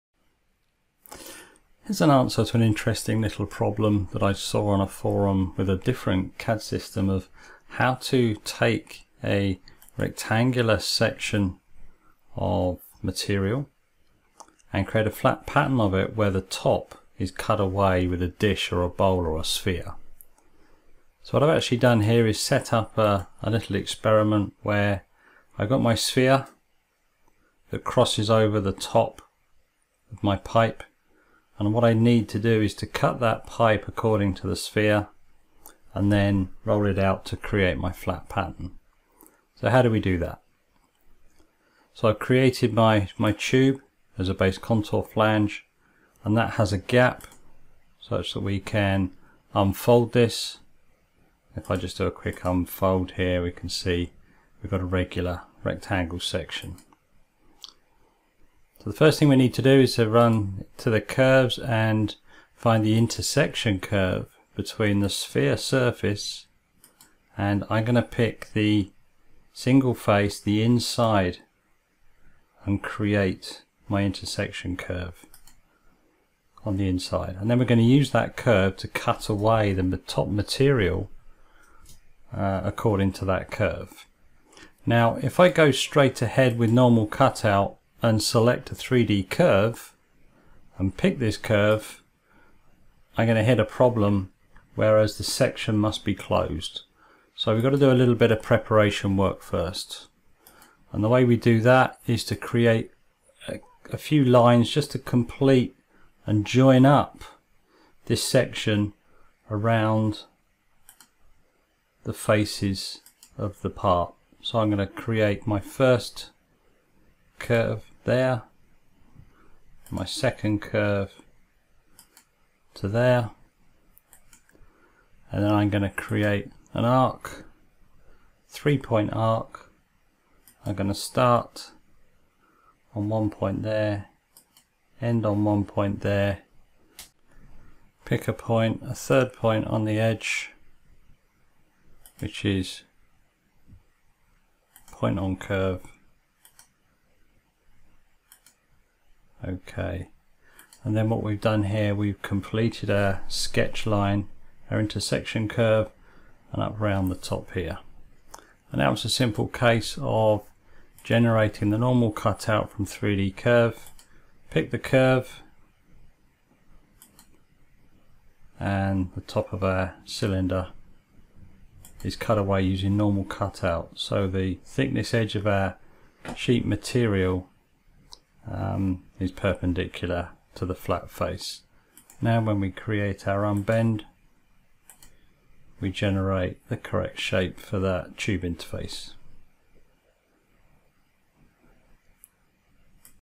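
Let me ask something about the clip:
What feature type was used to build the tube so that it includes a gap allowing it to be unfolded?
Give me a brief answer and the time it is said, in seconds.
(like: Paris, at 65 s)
base contour flange, at 44 s.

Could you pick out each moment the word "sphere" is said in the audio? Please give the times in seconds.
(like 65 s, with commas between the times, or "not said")
19 s, 25 s, 34 s, 65 s.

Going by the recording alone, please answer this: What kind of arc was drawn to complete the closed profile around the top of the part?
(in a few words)
three point arc.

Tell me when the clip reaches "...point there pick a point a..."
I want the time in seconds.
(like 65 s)
135 s.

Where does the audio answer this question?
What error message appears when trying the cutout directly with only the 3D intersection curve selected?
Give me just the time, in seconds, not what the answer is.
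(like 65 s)
95 s.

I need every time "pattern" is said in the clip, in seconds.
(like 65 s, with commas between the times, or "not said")
15 s, 38 s.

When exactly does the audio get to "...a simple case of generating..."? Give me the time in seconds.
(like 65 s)
159 s.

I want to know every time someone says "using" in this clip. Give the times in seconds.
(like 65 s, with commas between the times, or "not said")
172 s.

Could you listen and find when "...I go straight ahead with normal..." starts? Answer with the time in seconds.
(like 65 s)
85 s.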